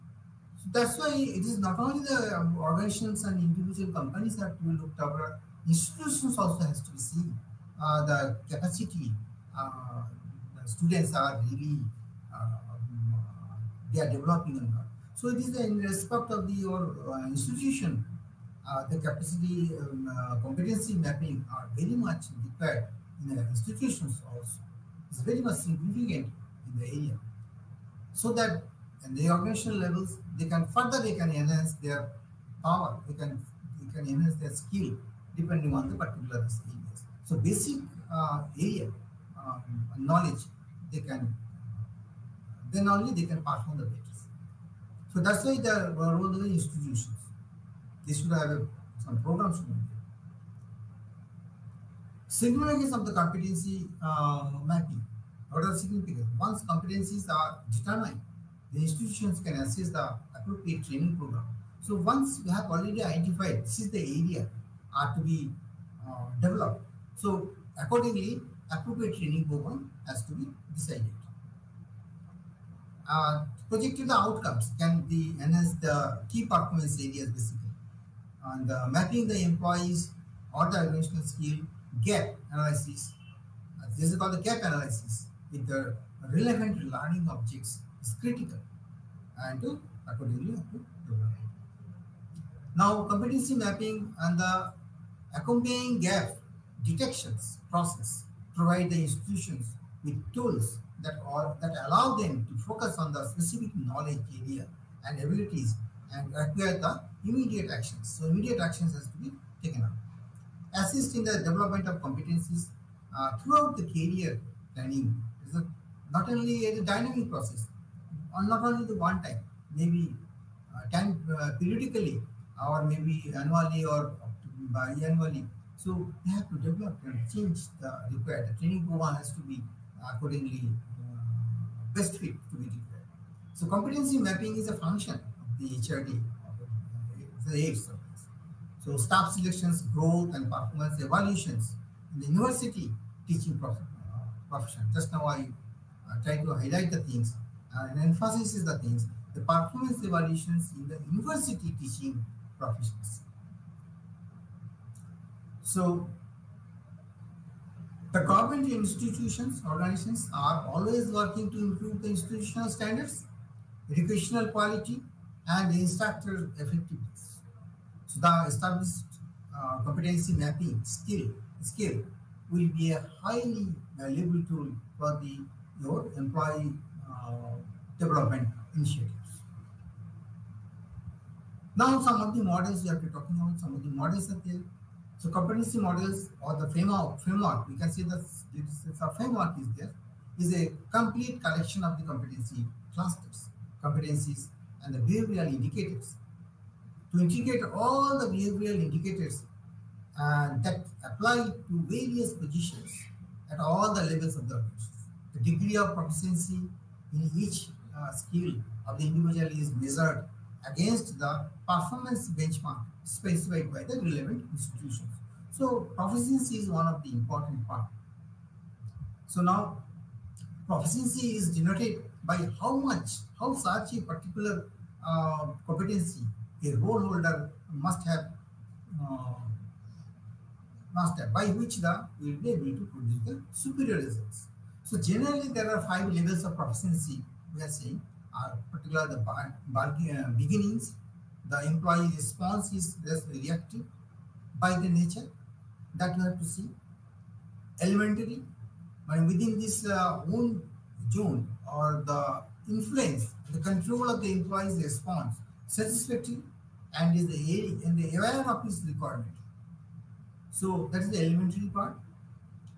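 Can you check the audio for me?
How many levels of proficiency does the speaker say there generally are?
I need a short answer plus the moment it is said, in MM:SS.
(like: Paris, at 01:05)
5, at 03:55.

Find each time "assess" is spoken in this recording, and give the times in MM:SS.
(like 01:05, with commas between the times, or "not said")
00:59.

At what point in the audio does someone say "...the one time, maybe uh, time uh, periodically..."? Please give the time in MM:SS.
01:58.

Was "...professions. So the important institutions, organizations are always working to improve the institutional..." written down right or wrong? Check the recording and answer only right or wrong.
wrong.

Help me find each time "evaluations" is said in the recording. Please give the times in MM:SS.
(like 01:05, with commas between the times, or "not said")
02:21, 02:30.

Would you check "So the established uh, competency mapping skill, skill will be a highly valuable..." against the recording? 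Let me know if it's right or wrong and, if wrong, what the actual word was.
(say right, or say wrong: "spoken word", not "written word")
right.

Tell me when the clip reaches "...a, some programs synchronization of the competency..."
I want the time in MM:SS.
00:48.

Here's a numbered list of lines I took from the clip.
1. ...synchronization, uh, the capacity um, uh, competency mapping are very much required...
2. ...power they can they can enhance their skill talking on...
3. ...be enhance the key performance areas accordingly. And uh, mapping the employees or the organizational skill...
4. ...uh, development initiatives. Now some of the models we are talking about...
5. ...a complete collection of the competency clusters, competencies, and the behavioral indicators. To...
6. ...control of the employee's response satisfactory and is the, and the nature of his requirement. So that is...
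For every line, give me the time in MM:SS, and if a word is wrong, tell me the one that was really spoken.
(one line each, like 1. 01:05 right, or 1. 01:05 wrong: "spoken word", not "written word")
1. 00:17 wrong: "institution", not "synchronization"
2. 00:32 wrong: "depending", not "talking"
3. 01:15 wrong: "basically", not "accordingly"
4. 02:57 right
5. 03:10 right
6. 04:13 wrong: "aware", not "nature".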